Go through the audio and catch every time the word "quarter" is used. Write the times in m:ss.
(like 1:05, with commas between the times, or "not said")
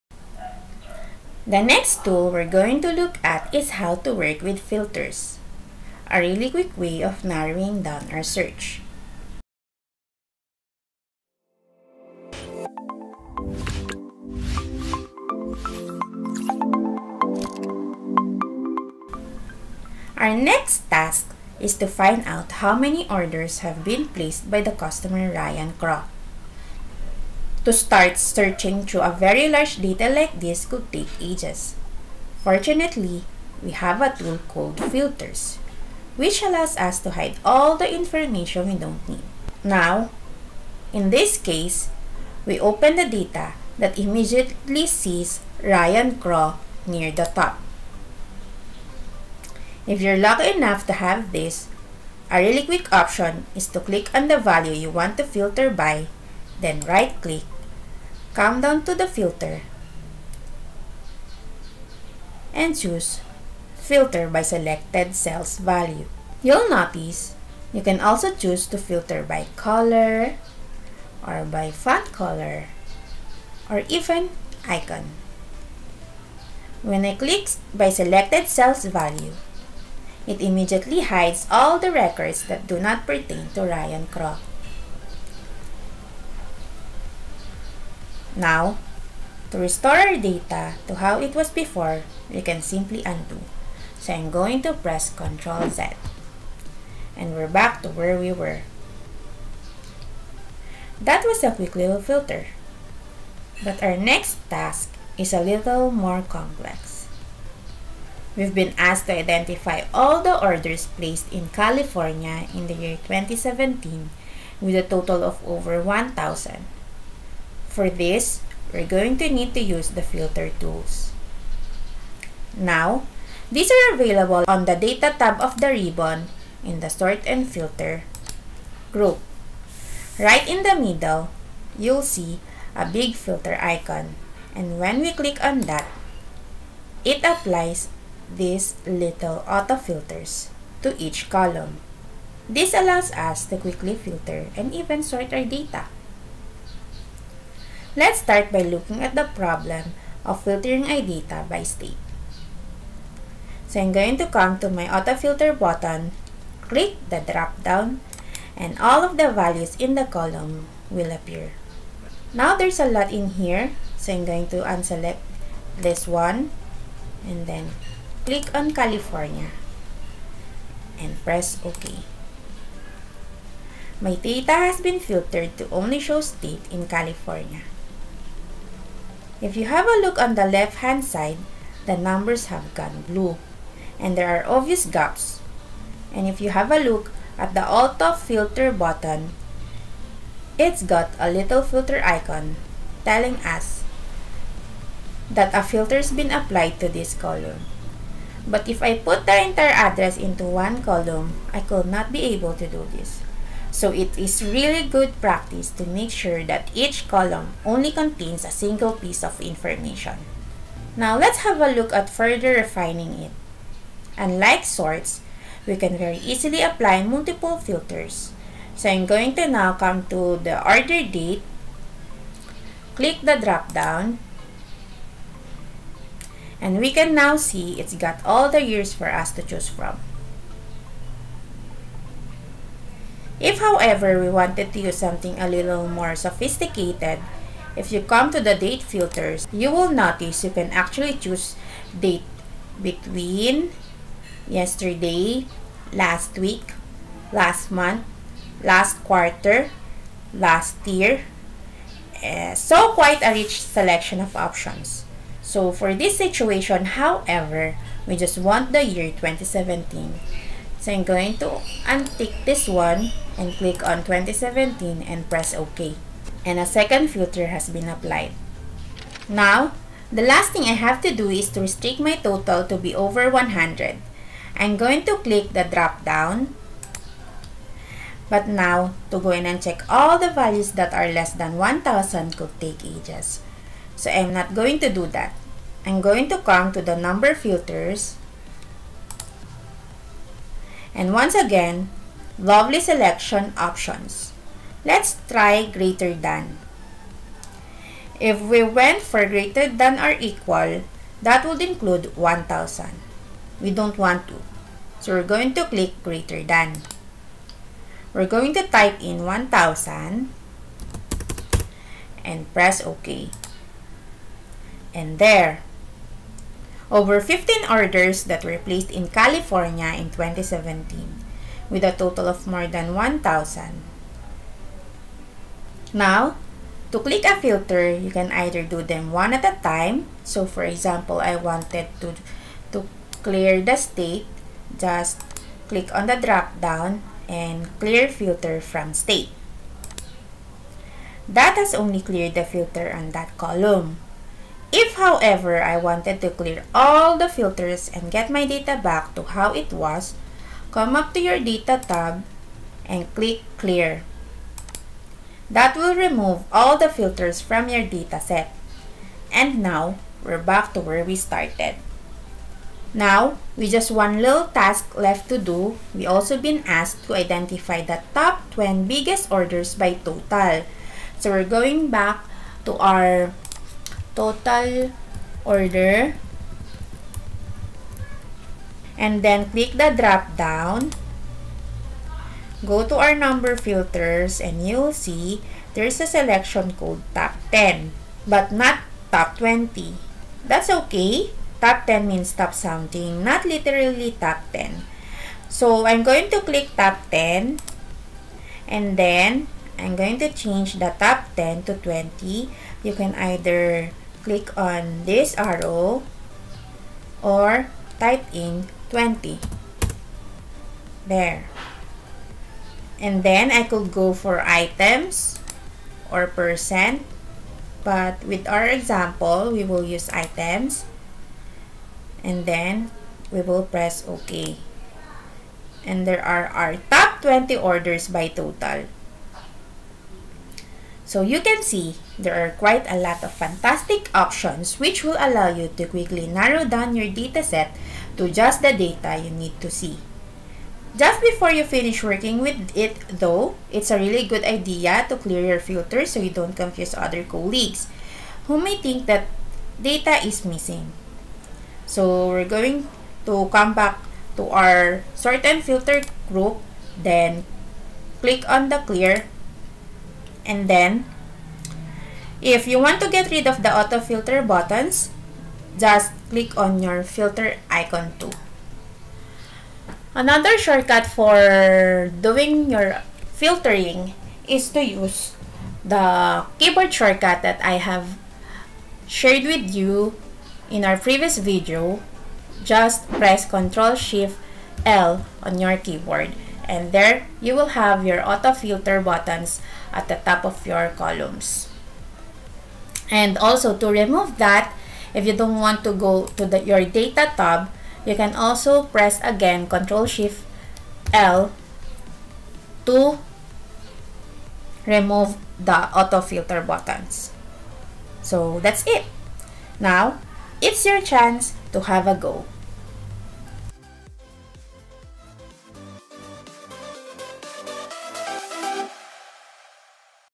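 4:09.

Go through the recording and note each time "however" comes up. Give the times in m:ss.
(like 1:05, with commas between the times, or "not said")
3:53, 4:16, 5:44.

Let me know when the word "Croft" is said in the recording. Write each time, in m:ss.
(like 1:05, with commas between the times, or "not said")
0:25, 0:46, 1:24.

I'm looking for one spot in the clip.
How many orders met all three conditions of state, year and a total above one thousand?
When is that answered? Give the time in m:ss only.
5:17.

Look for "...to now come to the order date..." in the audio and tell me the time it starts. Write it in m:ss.
3:39.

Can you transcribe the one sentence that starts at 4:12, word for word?
Uh, so quite a rich selection of options.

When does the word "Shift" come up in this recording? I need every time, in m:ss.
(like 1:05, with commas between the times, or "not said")
8:03, 8:20.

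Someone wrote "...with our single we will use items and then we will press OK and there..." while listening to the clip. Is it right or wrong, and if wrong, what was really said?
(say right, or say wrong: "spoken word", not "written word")
wrong: "example", not "single".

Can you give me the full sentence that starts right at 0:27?
To start searching through a very large data like this could take ages.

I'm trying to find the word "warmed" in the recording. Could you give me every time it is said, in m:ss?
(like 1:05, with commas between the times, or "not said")
not said.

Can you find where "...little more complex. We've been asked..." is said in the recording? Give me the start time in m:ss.
1:45.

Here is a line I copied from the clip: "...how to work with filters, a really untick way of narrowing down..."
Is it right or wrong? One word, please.
wrong.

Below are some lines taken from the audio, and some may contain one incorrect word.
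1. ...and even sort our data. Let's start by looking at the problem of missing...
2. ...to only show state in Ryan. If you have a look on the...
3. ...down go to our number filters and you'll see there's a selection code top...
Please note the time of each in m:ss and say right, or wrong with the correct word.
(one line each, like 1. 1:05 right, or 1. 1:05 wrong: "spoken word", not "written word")
1. 2:24 wrong: "filtering", not "missing"
2. 2:55 wrong: "California", not "Ryan"
3. 6:20 right.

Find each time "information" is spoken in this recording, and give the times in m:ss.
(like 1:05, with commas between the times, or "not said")
0:37, 3:29.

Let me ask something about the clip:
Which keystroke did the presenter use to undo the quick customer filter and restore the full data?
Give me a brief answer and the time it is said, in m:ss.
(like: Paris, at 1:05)
Ctrl Z, at 1:35.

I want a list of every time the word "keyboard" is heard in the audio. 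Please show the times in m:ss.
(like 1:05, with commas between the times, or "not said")
7:56, 8:05.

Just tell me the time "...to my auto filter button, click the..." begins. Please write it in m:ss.
2:34.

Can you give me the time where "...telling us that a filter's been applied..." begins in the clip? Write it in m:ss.
3:13.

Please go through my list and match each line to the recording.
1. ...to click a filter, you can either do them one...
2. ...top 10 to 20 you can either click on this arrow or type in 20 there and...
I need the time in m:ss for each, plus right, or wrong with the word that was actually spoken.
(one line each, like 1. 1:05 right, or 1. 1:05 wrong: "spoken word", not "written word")
1. 5:26 right
2. 6:40 right.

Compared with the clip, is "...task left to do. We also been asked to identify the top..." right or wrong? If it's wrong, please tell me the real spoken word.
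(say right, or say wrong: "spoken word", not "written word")
right.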